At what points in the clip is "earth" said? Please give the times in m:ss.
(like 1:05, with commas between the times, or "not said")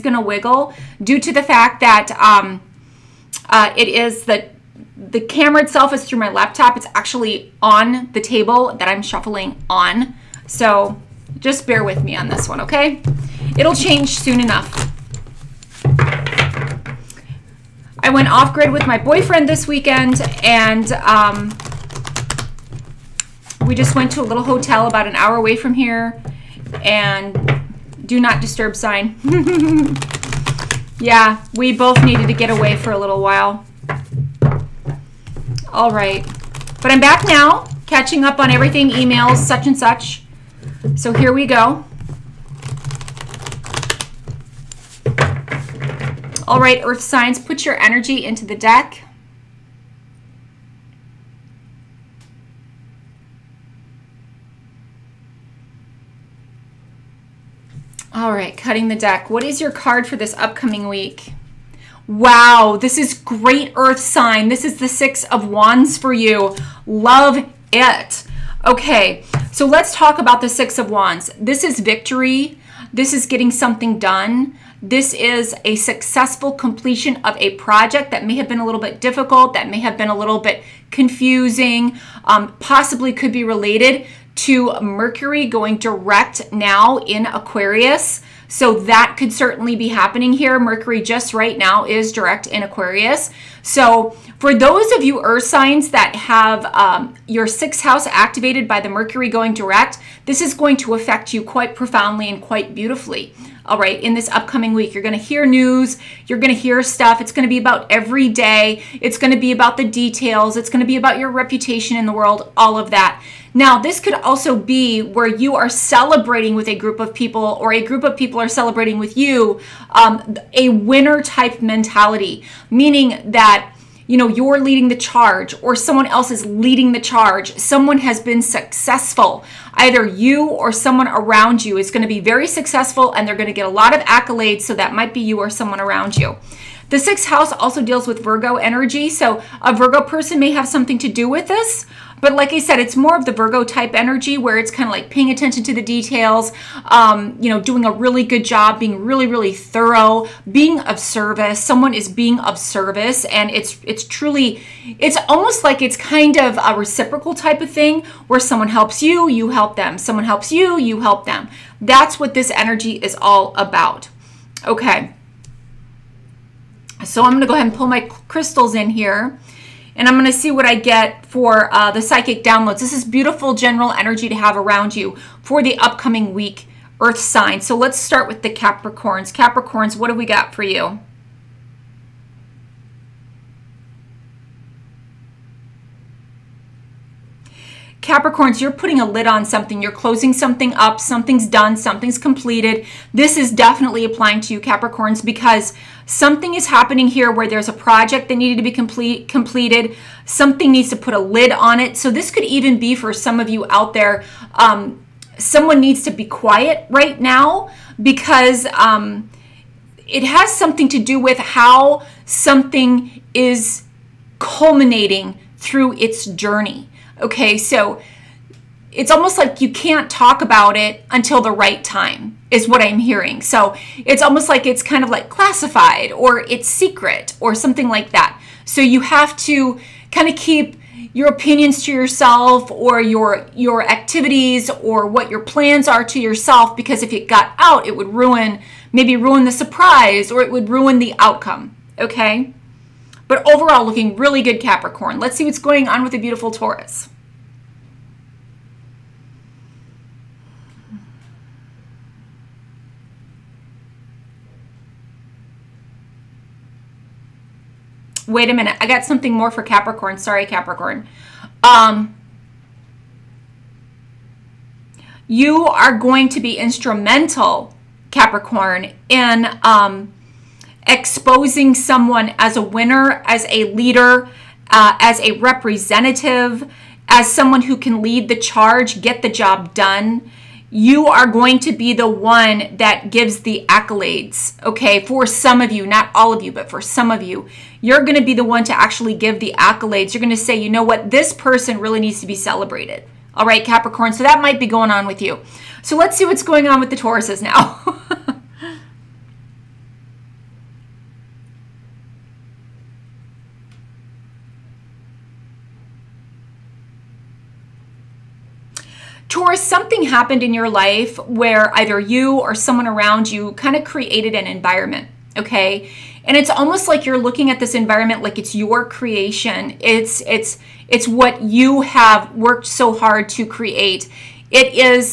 0:46, 1:03, 1:35, 2:57.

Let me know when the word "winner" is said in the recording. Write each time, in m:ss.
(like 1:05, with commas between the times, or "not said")
2:00, 4:32.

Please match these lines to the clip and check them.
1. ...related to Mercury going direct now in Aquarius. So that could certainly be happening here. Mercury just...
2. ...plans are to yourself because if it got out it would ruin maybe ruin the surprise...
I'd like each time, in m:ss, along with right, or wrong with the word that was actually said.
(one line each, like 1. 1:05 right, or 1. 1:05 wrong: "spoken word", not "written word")
1. 1:23 right
2. 3:55 right.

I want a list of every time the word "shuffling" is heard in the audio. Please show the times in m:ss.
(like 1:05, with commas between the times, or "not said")
0:09.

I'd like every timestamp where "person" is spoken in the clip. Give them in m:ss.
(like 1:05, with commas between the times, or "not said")
2:20, 4:51.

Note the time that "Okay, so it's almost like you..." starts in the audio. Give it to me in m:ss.
3:37.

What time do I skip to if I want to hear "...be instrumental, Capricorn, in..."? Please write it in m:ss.
4:26.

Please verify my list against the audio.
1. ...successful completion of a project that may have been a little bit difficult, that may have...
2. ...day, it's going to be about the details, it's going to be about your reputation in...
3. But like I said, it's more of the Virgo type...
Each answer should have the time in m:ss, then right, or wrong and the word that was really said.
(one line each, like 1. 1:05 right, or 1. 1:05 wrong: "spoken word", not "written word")
1. 1:15 right
2. 1:48 right
3. 2:22 right.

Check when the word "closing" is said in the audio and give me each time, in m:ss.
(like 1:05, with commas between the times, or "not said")
3:09.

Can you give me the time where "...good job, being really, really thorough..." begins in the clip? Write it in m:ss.
2:28.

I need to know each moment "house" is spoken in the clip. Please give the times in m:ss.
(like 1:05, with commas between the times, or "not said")
1:37, 2:17.